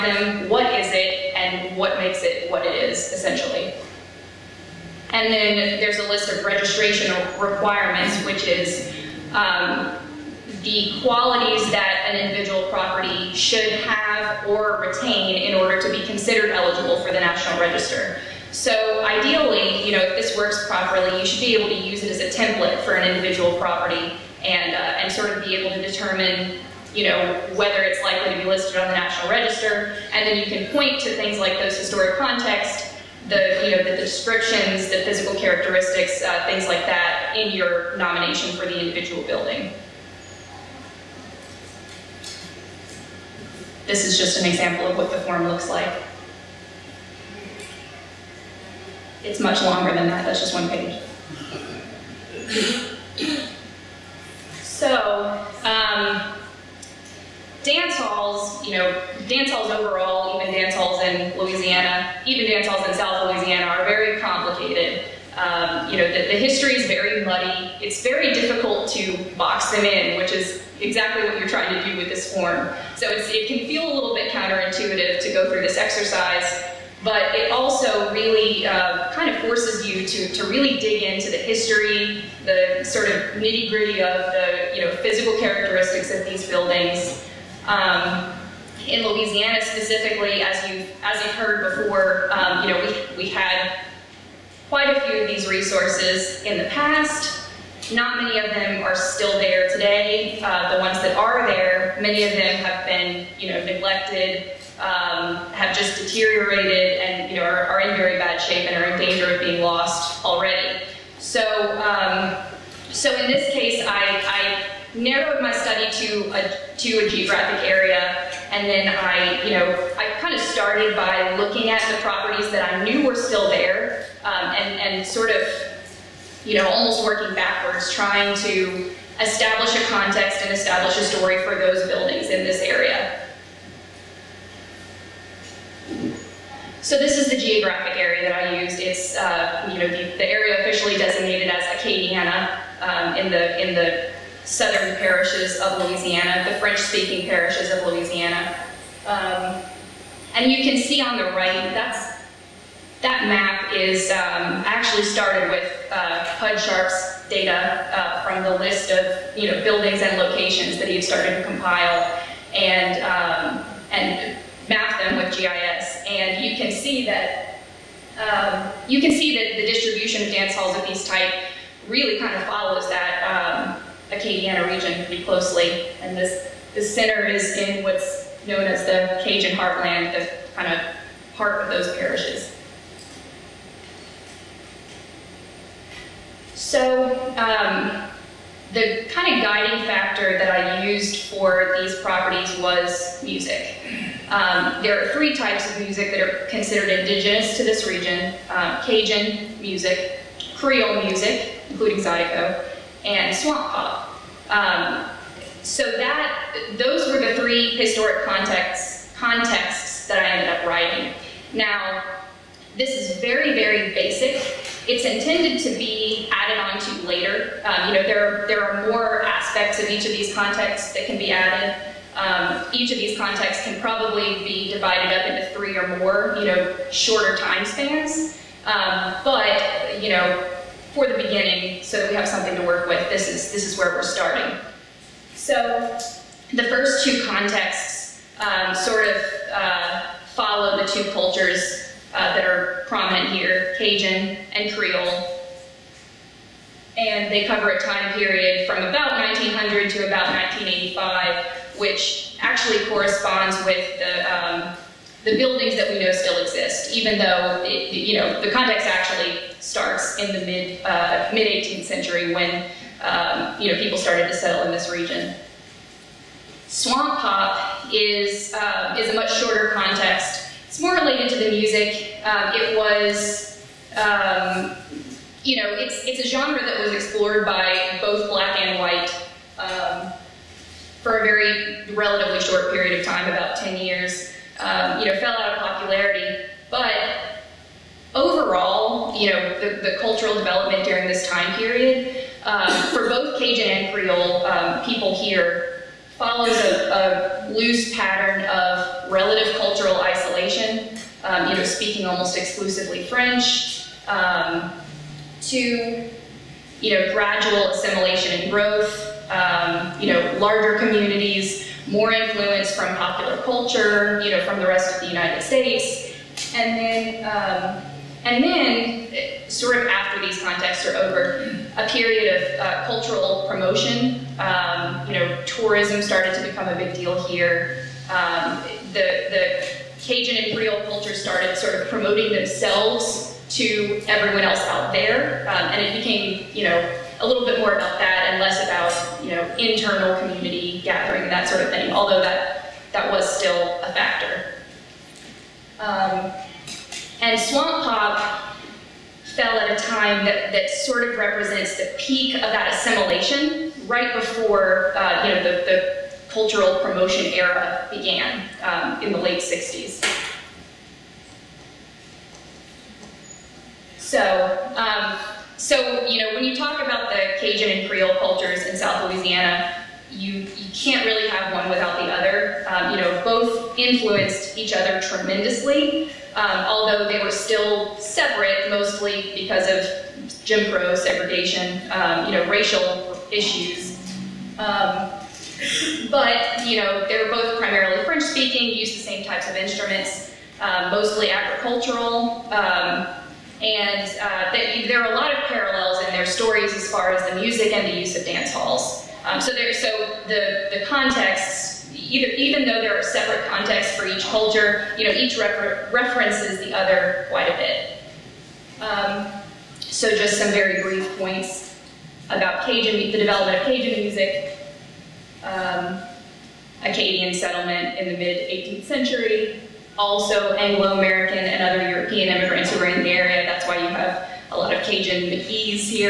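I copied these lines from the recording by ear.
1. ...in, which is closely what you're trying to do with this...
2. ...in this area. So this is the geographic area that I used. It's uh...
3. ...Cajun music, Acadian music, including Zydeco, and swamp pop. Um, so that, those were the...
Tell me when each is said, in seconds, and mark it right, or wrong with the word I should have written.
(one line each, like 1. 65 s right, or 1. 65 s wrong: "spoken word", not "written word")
1. 69 s wrong: "exactly", not "closely"
2. 132 s right
3. 198 s wrong: "Creole", not "Acadian".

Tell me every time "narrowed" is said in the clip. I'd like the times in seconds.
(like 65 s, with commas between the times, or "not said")
114 s.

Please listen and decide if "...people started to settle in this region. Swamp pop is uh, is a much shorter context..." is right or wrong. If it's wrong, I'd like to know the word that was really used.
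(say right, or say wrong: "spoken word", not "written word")
right.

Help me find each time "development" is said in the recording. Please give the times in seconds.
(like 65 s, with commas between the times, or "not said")
290 s, 413 s.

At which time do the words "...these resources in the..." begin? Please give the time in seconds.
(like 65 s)
95 s.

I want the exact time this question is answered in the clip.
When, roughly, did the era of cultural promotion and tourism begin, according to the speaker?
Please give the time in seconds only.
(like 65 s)
359 s.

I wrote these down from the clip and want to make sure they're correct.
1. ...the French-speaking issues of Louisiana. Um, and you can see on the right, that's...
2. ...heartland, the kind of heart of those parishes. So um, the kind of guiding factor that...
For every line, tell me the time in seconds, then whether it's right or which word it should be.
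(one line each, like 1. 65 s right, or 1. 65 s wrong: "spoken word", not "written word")
1. 146 s wrong: "parishes", not "issues"
2. 179 s right.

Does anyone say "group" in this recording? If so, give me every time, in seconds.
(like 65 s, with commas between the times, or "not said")
not said.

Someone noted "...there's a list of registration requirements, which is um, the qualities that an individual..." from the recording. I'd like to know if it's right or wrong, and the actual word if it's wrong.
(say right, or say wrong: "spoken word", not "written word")
right.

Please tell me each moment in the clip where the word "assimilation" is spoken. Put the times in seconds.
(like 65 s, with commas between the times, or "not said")
307 s, 352 s.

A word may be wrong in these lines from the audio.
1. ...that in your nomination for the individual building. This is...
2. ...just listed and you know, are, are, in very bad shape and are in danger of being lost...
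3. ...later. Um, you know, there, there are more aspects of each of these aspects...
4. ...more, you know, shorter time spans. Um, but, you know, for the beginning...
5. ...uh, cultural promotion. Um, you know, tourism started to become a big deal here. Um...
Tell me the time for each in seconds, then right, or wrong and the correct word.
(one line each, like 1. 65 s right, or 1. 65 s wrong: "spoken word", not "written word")
1. 36 s right
2. 105 s wrong: "deteriorated", not "listed"
3. 217 s wrong: "contexts", not "aspects"
4. 225 s right
5. 322 s right.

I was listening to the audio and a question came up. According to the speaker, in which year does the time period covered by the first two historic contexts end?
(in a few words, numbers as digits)
1985.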